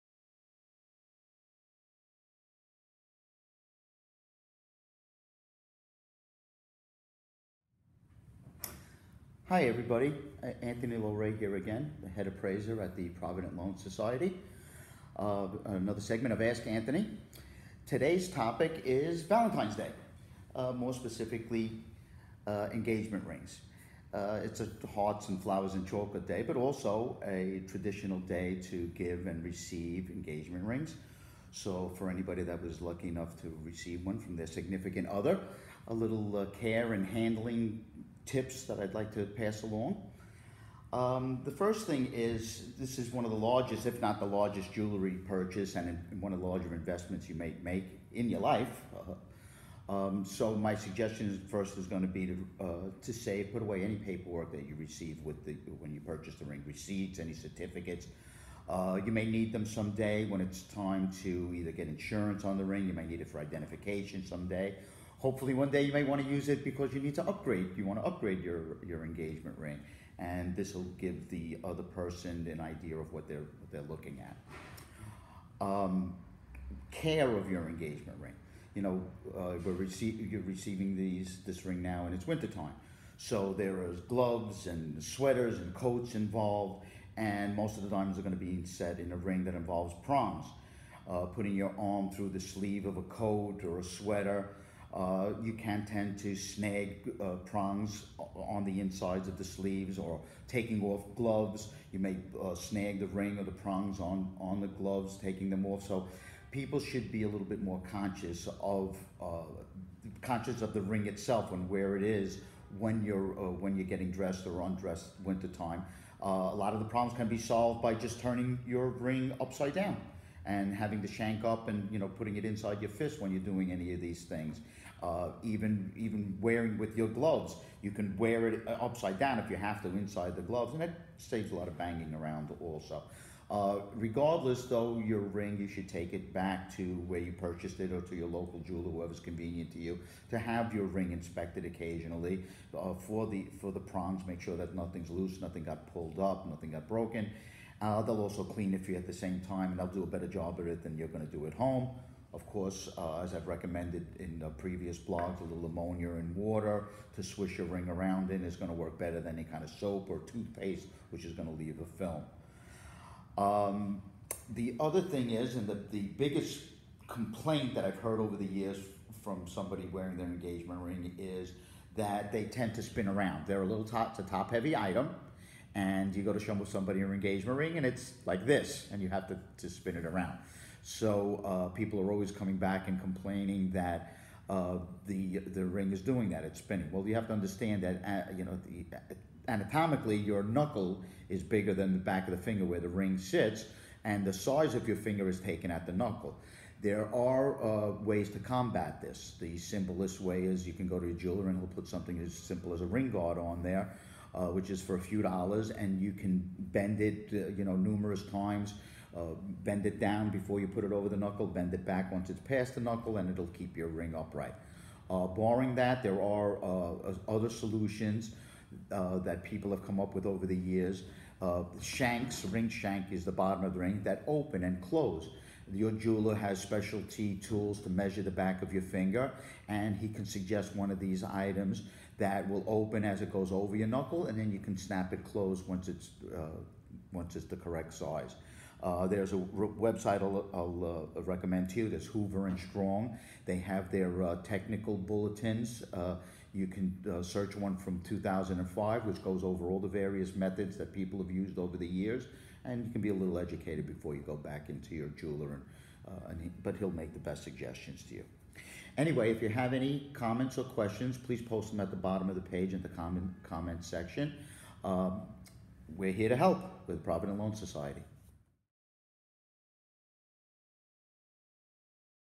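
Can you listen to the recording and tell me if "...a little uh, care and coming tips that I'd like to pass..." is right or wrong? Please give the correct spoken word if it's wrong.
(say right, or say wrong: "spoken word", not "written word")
wrong: "handling", not "coming".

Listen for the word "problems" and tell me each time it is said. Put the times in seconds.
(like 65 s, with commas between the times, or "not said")
116 s.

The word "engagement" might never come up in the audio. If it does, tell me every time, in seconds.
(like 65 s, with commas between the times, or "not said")
22 s, 30 s, 69 s, 77 s, 170 s, 177 s.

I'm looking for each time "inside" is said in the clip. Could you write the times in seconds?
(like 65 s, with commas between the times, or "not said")
98 s, 122 s, 129 s.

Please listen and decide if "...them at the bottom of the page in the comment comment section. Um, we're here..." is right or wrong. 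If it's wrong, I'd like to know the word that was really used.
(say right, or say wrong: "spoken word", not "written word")
right.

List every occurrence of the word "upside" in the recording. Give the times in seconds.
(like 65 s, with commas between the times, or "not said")
119 s, 128 s.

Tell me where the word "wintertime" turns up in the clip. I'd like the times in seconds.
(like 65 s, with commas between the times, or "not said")
82 s, 115 s.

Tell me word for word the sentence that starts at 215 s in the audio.
Uh, barring that, there are uh, other solutions uh, that people have come up with over the years.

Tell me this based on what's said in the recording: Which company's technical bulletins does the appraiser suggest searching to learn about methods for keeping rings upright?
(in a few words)
Hoover and Strong.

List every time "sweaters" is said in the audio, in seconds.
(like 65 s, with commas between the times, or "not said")
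85 s, 93 s.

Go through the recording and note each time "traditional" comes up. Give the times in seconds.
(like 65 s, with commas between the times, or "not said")
27 s.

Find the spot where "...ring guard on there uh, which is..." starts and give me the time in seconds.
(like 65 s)
202 s.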